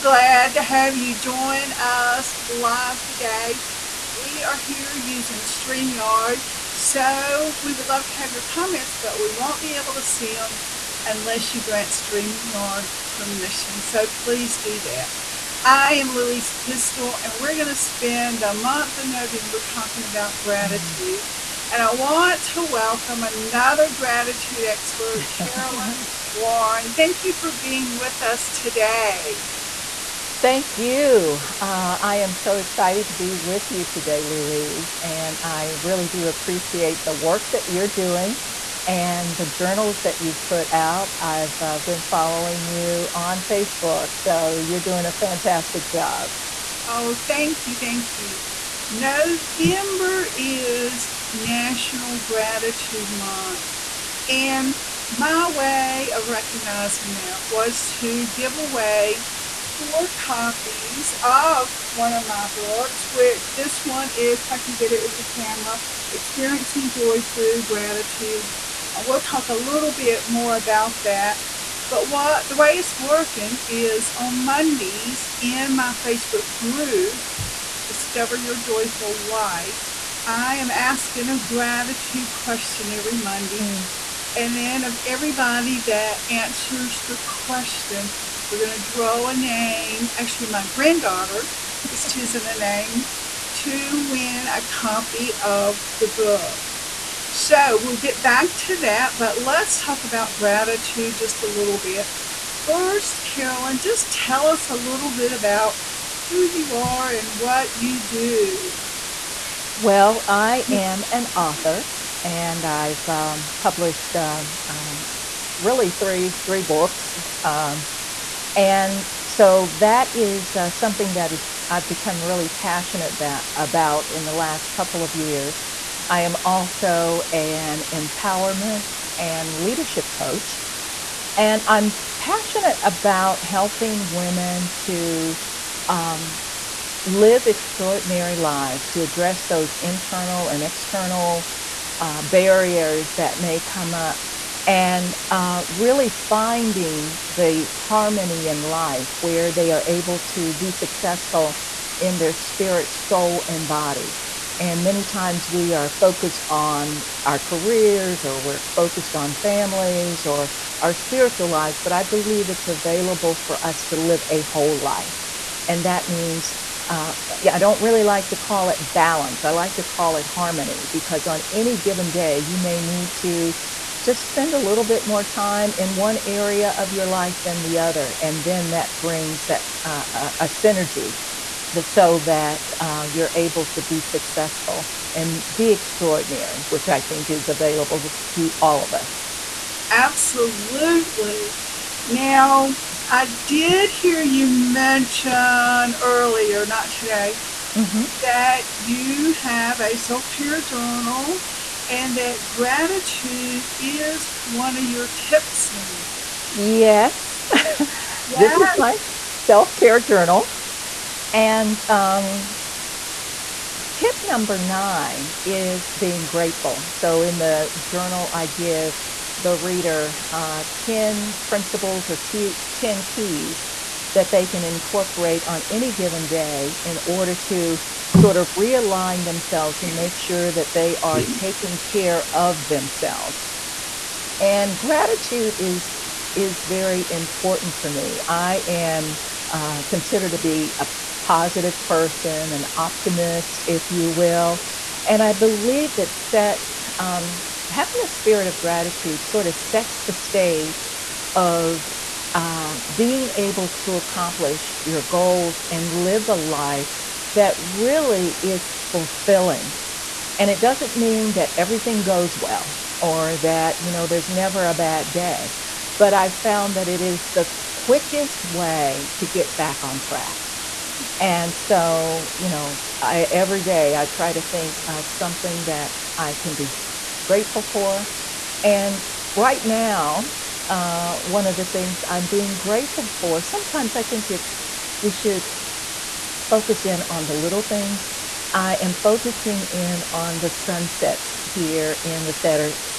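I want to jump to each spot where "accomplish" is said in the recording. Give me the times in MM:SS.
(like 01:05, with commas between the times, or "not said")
04:13.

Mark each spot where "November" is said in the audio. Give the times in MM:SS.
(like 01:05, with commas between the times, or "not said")
00:19, 00:48.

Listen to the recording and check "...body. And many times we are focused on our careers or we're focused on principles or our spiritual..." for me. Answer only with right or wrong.
wrong.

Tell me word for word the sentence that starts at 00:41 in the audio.
I've uh, been following you on Facebook, so you're doing a fantastic job.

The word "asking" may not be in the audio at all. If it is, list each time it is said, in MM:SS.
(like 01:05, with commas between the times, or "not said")
01:20.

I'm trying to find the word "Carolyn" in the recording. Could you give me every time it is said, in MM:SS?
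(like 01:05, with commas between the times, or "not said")
00:25, 01:43.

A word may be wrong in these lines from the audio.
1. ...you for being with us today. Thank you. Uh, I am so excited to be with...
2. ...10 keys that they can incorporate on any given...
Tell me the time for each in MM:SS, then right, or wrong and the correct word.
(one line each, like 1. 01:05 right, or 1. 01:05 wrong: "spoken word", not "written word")
1. 00:27 right
2. 03:42 right.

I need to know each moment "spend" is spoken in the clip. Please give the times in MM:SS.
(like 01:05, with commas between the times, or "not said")
00:17, 02:54.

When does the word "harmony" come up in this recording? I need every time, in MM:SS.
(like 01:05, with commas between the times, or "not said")
02:27, 02:50.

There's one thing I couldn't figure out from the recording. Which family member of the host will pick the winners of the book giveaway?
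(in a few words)
granddaughter.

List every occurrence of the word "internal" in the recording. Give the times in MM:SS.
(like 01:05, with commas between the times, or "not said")
02:19.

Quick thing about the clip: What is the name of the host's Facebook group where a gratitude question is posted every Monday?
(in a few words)
Discover Your Joyful Light.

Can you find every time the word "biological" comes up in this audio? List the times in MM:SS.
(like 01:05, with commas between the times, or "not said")
not said.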